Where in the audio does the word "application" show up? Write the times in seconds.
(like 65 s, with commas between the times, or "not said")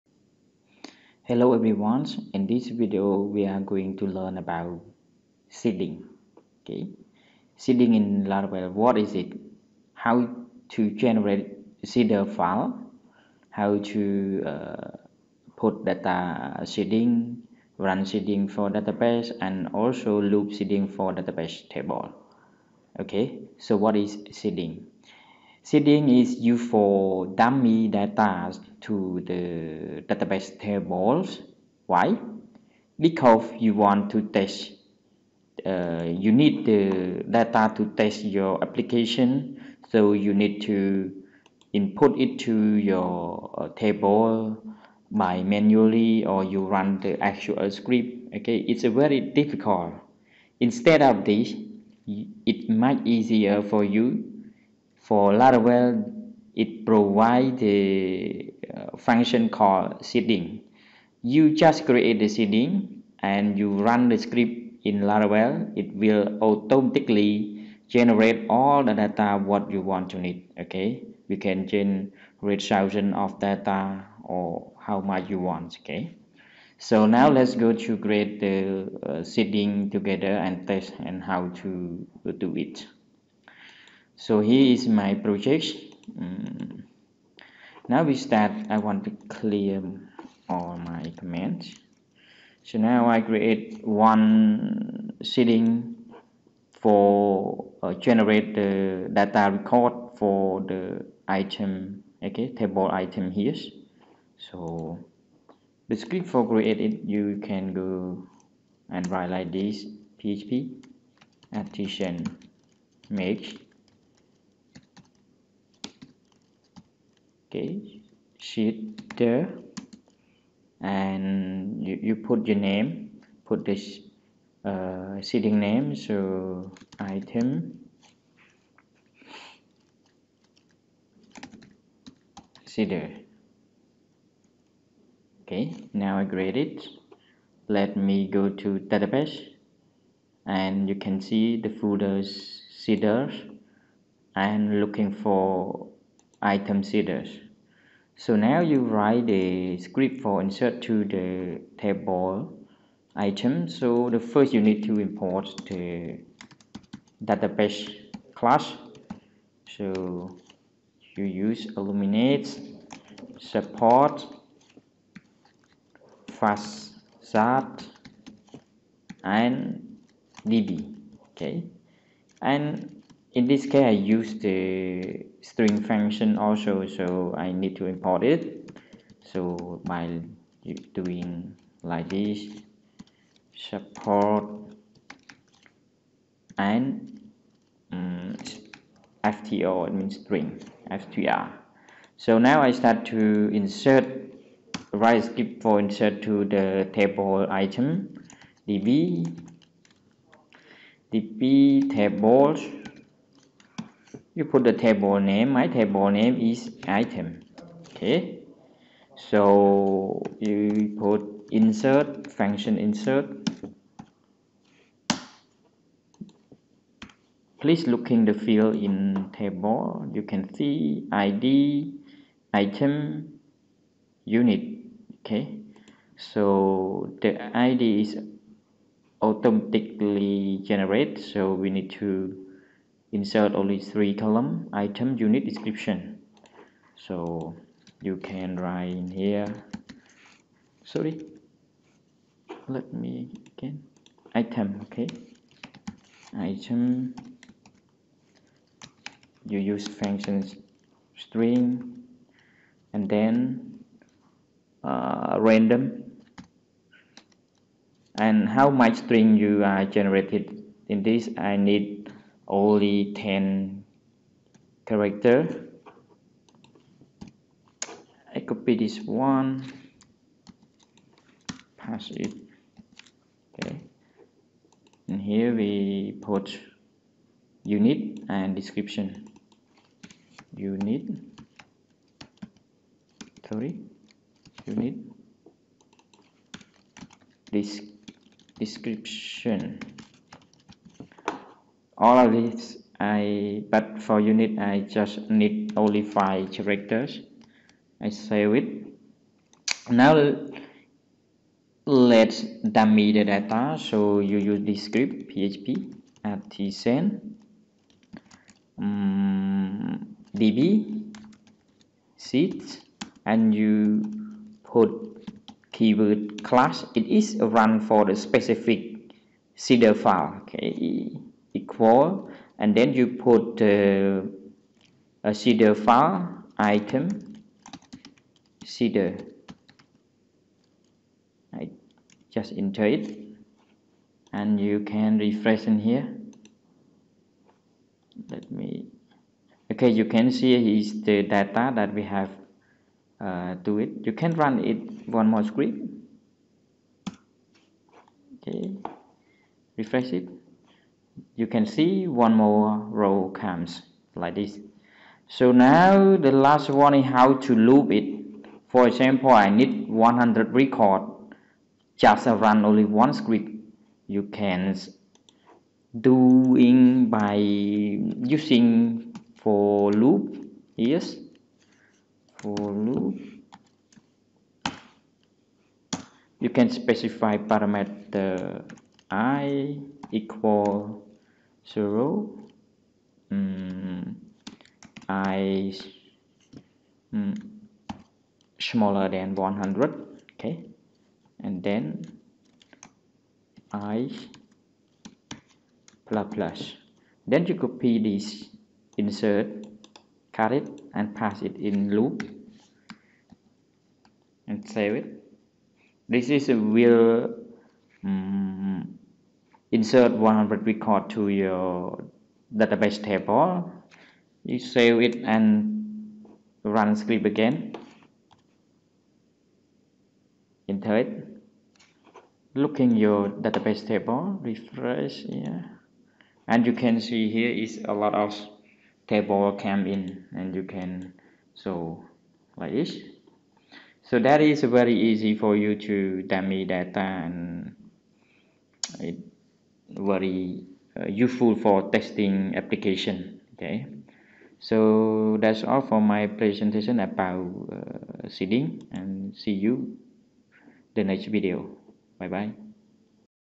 38 s, 442 s.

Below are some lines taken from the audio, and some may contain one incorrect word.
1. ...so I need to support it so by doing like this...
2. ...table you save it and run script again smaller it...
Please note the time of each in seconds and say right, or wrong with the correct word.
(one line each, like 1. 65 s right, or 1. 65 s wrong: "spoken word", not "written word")
1. 176 s wrong: "import", not "support"
2. 413 s wrong: "enter", not "smaller".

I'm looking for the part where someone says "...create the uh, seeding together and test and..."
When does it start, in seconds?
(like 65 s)
77 s.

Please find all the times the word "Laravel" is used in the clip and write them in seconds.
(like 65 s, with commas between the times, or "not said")
8 s, 55 s, 65 s.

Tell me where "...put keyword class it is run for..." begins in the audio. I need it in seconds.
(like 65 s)
314 s.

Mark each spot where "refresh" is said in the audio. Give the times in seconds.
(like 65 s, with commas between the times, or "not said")
335 s, 349 s, 424 s.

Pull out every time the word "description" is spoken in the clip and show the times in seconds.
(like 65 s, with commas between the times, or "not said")
235 s, 278 s, 288 s.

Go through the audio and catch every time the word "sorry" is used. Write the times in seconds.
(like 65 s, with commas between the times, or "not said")
240 s, 283 s.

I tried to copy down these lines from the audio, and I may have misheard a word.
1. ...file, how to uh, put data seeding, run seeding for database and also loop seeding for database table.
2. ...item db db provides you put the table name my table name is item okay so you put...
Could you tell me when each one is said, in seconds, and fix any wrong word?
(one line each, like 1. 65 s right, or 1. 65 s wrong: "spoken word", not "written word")
1. 12 s right
2. 197 s wrong: "tables", not "provides".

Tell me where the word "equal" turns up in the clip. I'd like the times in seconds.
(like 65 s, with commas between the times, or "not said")
321 s, 380 s.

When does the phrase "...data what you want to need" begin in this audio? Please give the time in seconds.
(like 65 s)
68 s.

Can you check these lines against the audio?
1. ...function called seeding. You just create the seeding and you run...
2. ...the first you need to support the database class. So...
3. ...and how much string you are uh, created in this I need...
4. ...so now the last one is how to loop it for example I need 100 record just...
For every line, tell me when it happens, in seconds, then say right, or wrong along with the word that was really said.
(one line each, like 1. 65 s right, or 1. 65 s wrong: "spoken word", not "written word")
1. 58 s right
2. 154 s wrong: "import", not "support"
3. 258 s wrong: "generated", not "created"
4. 355 s right.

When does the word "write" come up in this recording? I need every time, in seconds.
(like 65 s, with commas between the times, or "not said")
109 s, 148 s, 238 s.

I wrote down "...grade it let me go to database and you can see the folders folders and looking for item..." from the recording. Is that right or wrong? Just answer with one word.
wrong.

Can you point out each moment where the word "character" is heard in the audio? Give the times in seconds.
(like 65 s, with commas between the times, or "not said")
264 s, 296 s.